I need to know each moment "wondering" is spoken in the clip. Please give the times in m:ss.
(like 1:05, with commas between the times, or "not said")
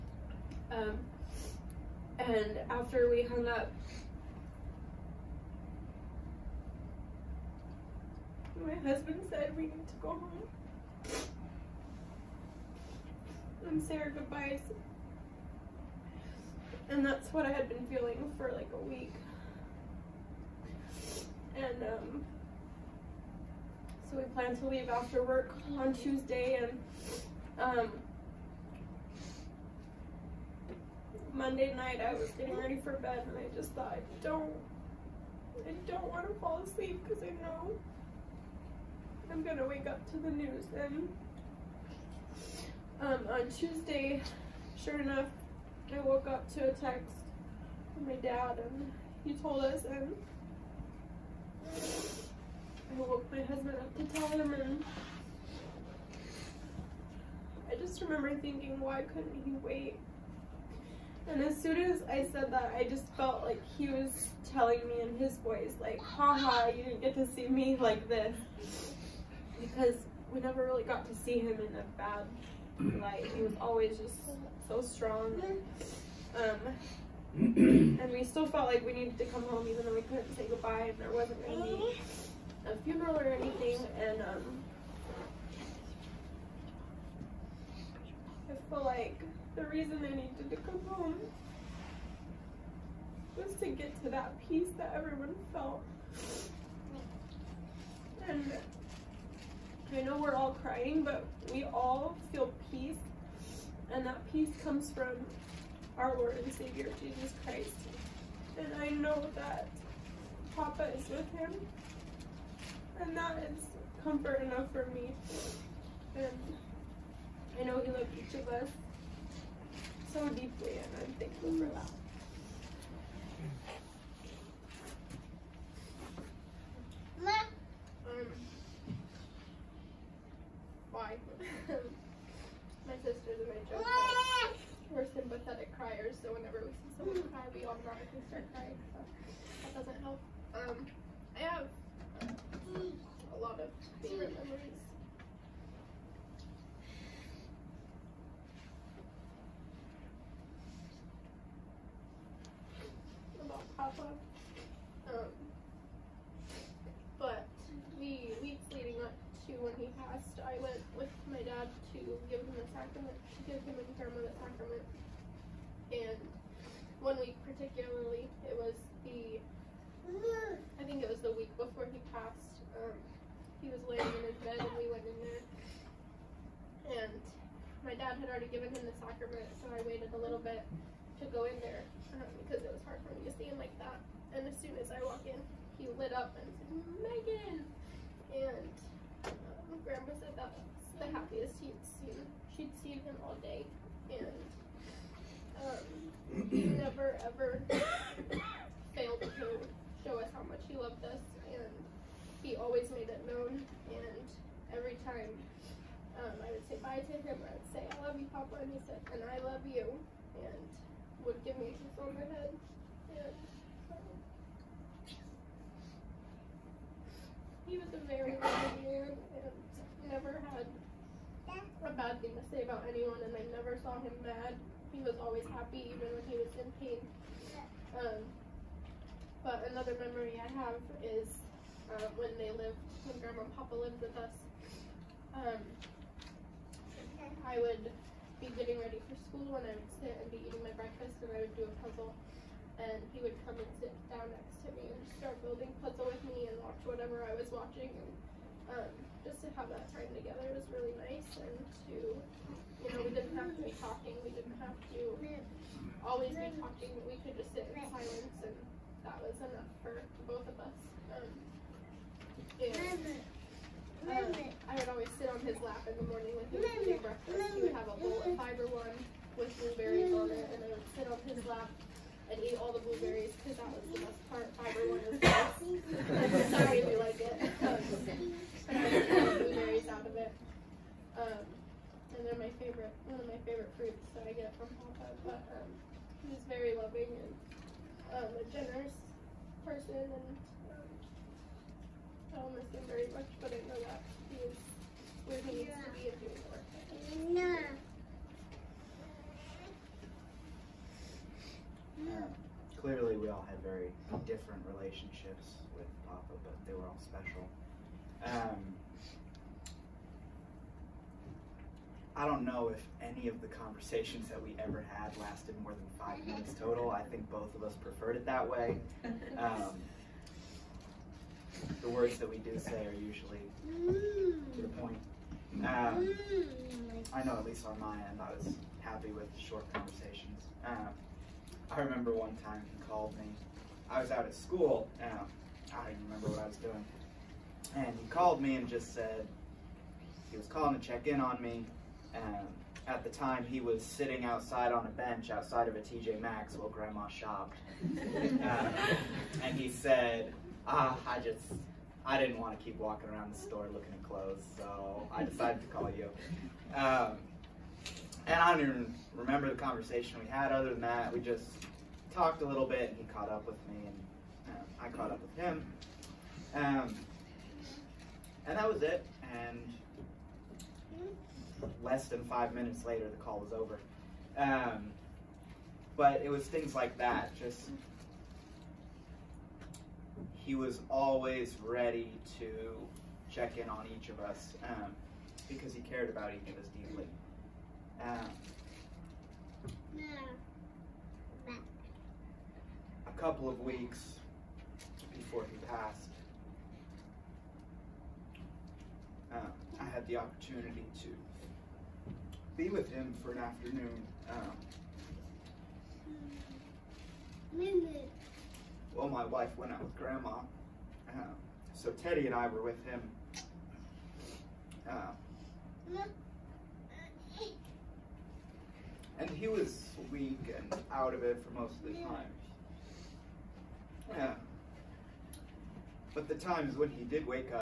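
not said.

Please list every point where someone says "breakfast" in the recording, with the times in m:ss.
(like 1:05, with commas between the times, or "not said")
4:00, 4:27.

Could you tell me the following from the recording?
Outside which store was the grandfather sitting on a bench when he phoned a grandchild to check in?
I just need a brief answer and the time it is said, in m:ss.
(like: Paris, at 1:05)
TJ Maxx, at 5:45.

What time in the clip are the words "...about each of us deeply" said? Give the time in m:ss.
6:26.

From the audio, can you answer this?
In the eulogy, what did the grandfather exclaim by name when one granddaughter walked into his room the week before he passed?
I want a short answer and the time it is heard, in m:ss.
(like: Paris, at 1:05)
Megan, at 3:07.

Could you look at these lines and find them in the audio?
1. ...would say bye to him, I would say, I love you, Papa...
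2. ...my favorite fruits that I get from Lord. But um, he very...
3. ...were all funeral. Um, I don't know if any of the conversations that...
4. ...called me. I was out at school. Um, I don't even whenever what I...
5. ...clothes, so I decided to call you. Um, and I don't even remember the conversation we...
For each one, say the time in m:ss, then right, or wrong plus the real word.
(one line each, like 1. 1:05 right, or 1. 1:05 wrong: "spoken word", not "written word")
1. 3:26 right
2. 4:43 wrong: "Papa", not "Lord"
3. 5:06 wrong: "special", not "funeral"
4. 5:32 wrong: "remember", not "whenever"
5. 5:54 right.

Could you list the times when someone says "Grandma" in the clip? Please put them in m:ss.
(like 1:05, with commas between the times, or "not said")
3:09, 3:53, 5:46, 6:49.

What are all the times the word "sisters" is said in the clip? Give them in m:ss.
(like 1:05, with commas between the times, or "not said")
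2:13.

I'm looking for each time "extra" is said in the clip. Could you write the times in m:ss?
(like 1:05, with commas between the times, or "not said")
not said.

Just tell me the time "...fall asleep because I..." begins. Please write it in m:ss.
0:36.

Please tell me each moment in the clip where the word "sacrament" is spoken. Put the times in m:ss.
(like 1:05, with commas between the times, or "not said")
2:44, 2:59.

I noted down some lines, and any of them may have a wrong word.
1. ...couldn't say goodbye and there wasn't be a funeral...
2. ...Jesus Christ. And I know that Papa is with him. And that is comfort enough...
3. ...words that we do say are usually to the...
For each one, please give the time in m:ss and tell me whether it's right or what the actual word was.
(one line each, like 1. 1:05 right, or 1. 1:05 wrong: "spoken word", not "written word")
1. 1:20 right
2. 1:47 right
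3. 5:21 right.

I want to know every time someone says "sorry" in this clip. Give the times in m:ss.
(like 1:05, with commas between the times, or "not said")
4:36.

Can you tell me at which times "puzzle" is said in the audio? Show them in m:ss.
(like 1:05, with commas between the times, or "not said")
4:01, 4:05.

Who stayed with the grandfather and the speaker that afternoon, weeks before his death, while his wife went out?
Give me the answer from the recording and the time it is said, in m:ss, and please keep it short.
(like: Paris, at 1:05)
Teddy, at 6:51.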